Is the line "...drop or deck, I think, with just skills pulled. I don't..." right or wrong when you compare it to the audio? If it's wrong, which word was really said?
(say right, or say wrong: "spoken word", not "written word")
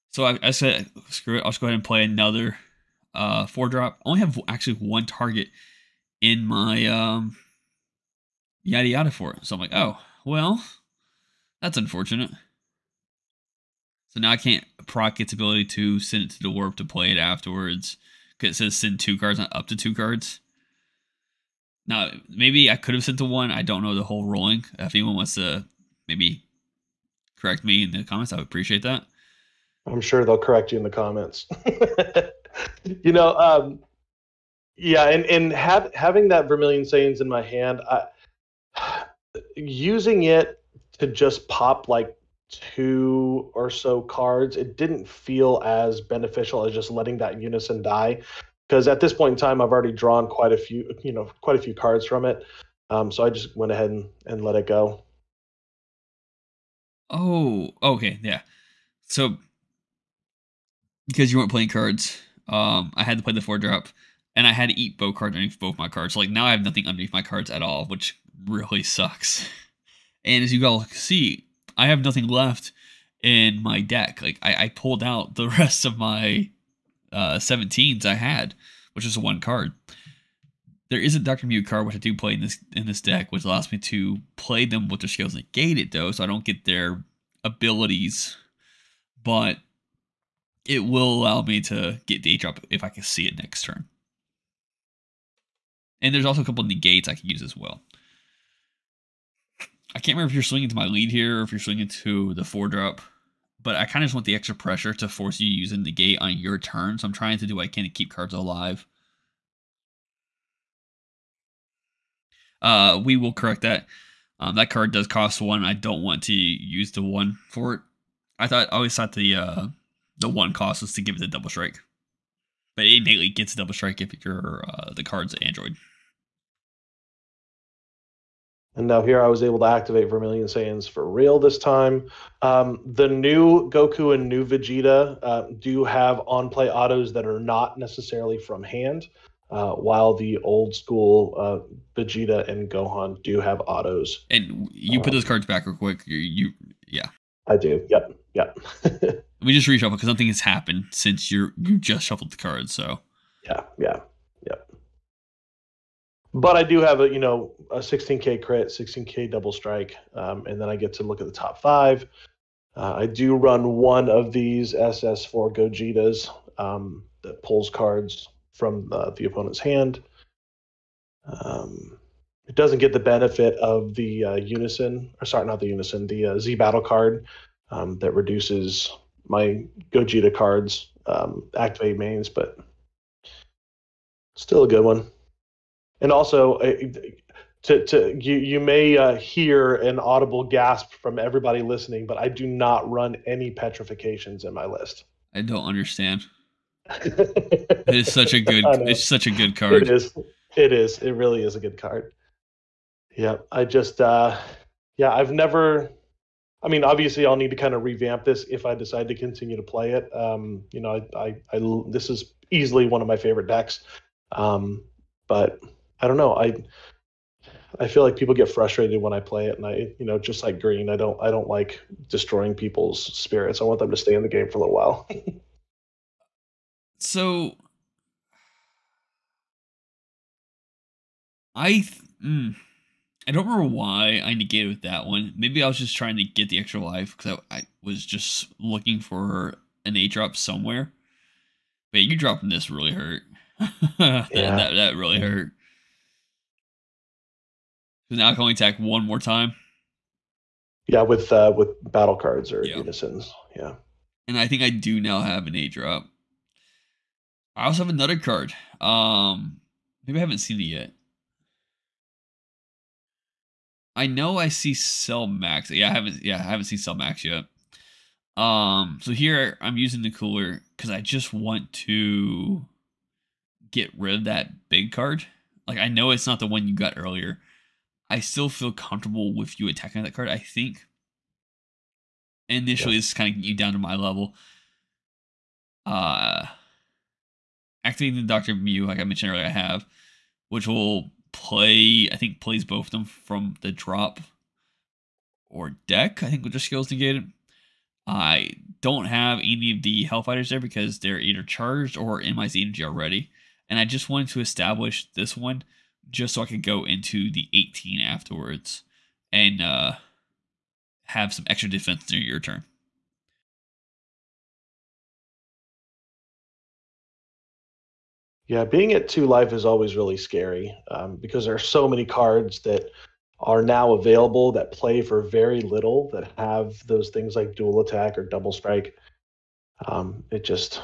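wrong: "negated", not "pulled".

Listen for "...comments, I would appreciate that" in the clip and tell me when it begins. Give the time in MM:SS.
00:28.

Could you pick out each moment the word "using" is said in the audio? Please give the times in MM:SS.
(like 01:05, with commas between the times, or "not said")
00:39, 01:45, 04:29.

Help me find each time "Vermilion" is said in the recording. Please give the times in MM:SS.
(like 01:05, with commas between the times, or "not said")
00:36, 02:10.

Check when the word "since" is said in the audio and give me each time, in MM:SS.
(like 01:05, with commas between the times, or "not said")
02:30.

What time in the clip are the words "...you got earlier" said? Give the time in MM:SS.
04:36.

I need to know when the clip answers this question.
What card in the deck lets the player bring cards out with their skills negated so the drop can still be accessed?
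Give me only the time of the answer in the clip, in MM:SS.
01:21.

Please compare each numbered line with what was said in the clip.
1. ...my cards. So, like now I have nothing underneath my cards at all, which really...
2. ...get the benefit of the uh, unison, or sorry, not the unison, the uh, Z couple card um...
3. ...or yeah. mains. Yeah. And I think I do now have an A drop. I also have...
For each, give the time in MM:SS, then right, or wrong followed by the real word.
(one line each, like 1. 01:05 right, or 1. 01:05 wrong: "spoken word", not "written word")
1. 01:05 right
2. 02:52 wrong: "battle", not "couple"
3. 04:12 wrong: "unisons", not "mains".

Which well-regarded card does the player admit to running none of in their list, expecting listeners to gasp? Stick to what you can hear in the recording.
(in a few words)
petrifications.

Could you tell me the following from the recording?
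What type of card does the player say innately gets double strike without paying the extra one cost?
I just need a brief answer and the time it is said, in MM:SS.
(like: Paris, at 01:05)
Android, at 02:05.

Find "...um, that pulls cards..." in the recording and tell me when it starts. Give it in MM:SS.
02:46.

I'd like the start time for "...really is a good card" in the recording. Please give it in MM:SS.
03:21.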